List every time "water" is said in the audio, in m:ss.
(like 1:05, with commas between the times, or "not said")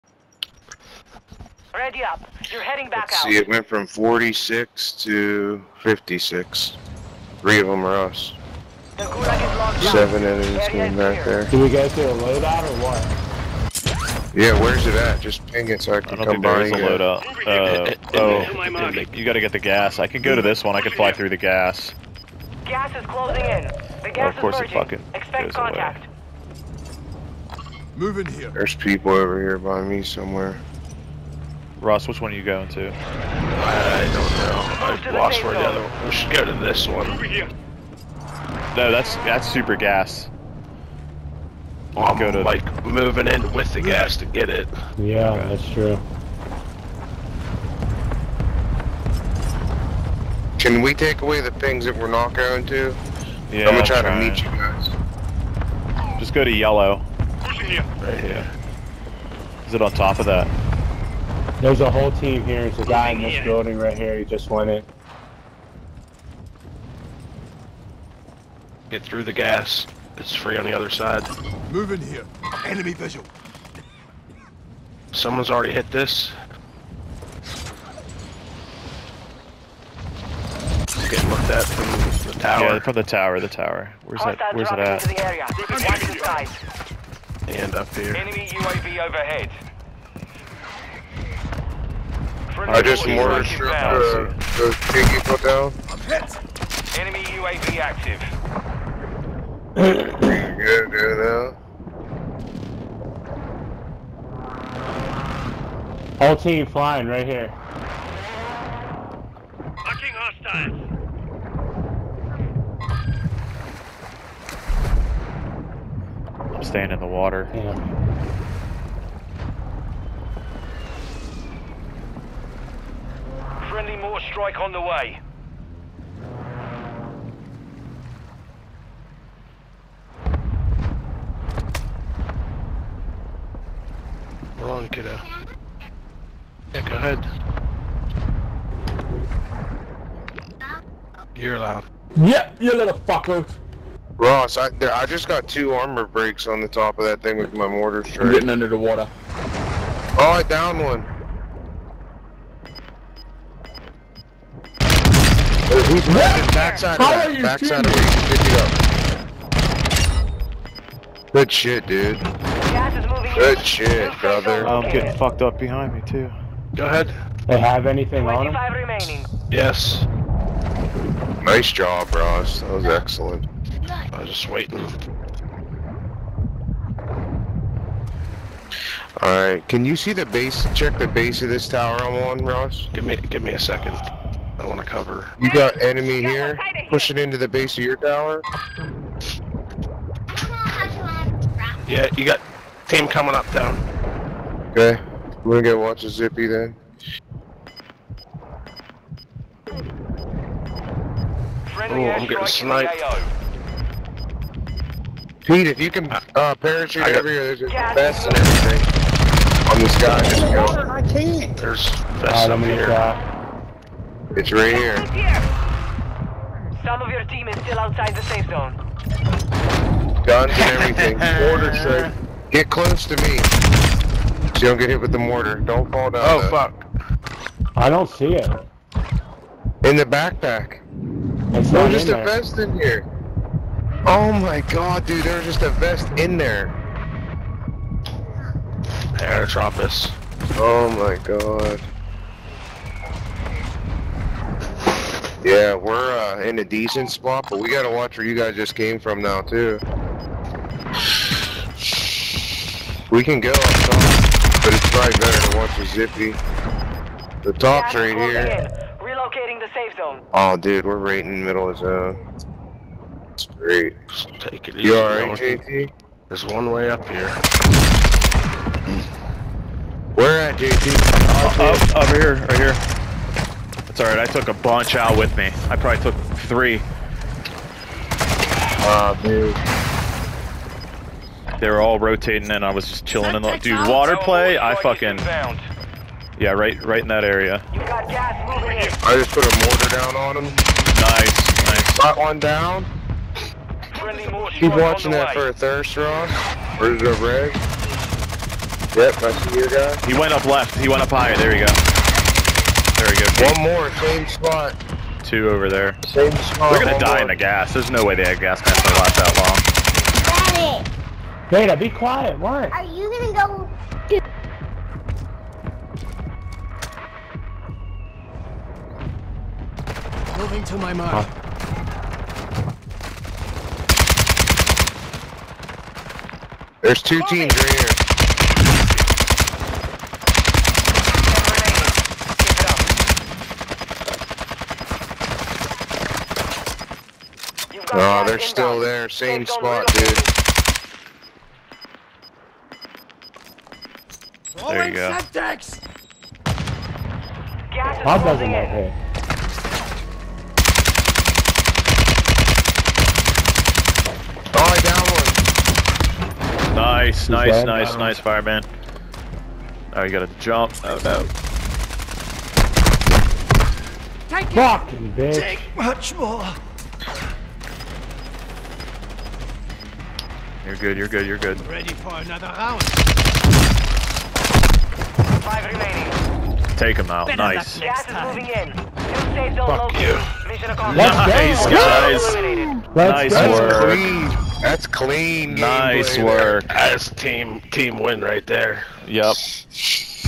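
1:57, 2:28, 4:43.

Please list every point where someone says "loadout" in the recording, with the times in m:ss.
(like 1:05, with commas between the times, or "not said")
0:12, 0:16.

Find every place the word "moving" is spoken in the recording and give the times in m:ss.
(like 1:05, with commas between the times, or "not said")
0:42, 5:20, 6:18.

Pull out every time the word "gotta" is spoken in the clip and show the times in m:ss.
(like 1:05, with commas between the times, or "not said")
0:19, 4:07, 6:00.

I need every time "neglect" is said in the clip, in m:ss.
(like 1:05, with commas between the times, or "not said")
not said.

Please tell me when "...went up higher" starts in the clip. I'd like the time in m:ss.
5:00.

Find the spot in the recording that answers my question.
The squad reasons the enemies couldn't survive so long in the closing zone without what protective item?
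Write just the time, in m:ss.
5:08.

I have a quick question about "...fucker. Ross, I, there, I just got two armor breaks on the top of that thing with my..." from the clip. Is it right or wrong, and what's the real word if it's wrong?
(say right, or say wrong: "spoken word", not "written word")
right.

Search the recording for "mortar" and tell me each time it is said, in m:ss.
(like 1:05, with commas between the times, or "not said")
1:33, 2:03, 2:27, 3:41, 3:45, 4:49.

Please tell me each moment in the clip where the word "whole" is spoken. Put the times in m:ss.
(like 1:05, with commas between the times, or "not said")
1:01, 1:46.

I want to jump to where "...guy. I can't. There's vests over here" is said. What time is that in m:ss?
3:29.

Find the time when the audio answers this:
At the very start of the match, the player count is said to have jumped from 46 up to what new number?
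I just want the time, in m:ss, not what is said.
0:05.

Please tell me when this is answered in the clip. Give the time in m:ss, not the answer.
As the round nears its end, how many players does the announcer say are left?
6:15.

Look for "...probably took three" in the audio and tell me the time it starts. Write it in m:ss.
4:35.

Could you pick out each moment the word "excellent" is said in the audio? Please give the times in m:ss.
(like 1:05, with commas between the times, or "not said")
2:52.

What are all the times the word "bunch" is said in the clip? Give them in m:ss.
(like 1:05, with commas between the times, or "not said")
4:34.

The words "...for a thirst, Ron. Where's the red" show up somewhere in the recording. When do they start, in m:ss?
4:55.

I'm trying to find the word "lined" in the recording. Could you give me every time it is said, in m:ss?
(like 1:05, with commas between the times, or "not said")
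not said.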